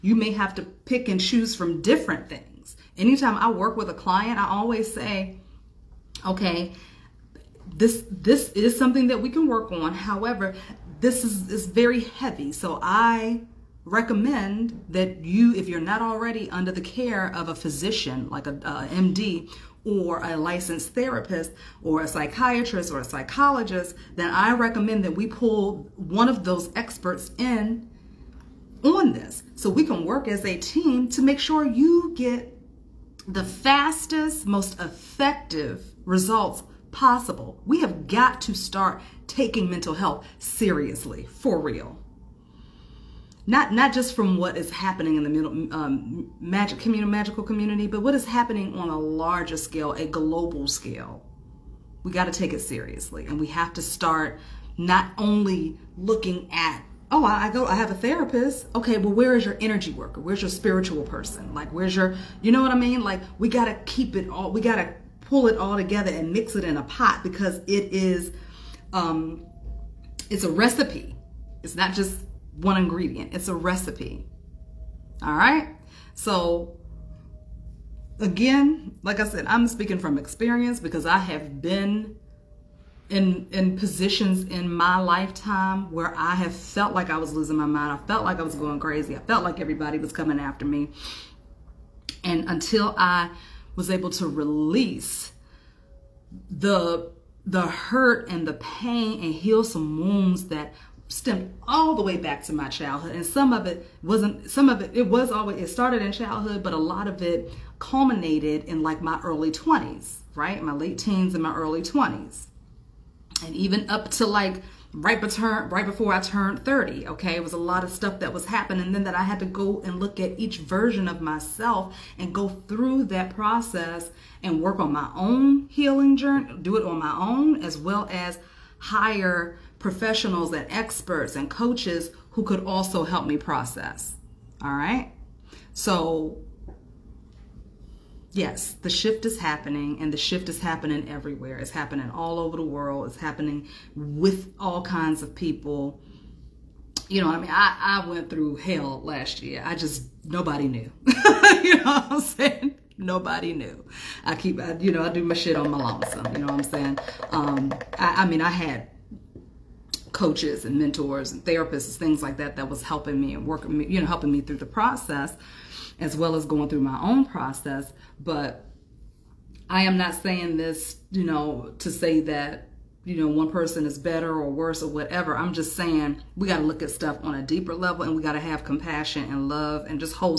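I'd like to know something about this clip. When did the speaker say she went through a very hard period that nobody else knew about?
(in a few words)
Last year.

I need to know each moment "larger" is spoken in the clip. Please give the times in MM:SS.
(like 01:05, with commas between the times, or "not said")
00:48.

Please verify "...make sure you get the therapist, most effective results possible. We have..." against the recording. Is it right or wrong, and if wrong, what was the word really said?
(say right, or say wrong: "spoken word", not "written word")
wrong: "fastest", not "therapist".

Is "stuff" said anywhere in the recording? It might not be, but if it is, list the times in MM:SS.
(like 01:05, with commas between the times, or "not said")
01:57, 02:56.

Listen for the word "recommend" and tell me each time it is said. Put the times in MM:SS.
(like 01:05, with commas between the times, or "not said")
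00:13, 00:24.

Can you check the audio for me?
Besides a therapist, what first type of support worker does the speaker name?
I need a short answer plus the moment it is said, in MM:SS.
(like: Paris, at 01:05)
Energy worker, at 00:59.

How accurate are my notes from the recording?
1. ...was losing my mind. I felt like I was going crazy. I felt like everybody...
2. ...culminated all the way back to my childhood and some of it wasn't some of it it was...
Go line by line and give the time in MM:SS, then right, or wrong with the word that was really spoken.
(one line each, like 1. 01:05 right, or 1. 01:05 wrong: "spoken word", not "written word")
1. 01:27 right
2. 01:41 wrong: "stemmed", not "culminated".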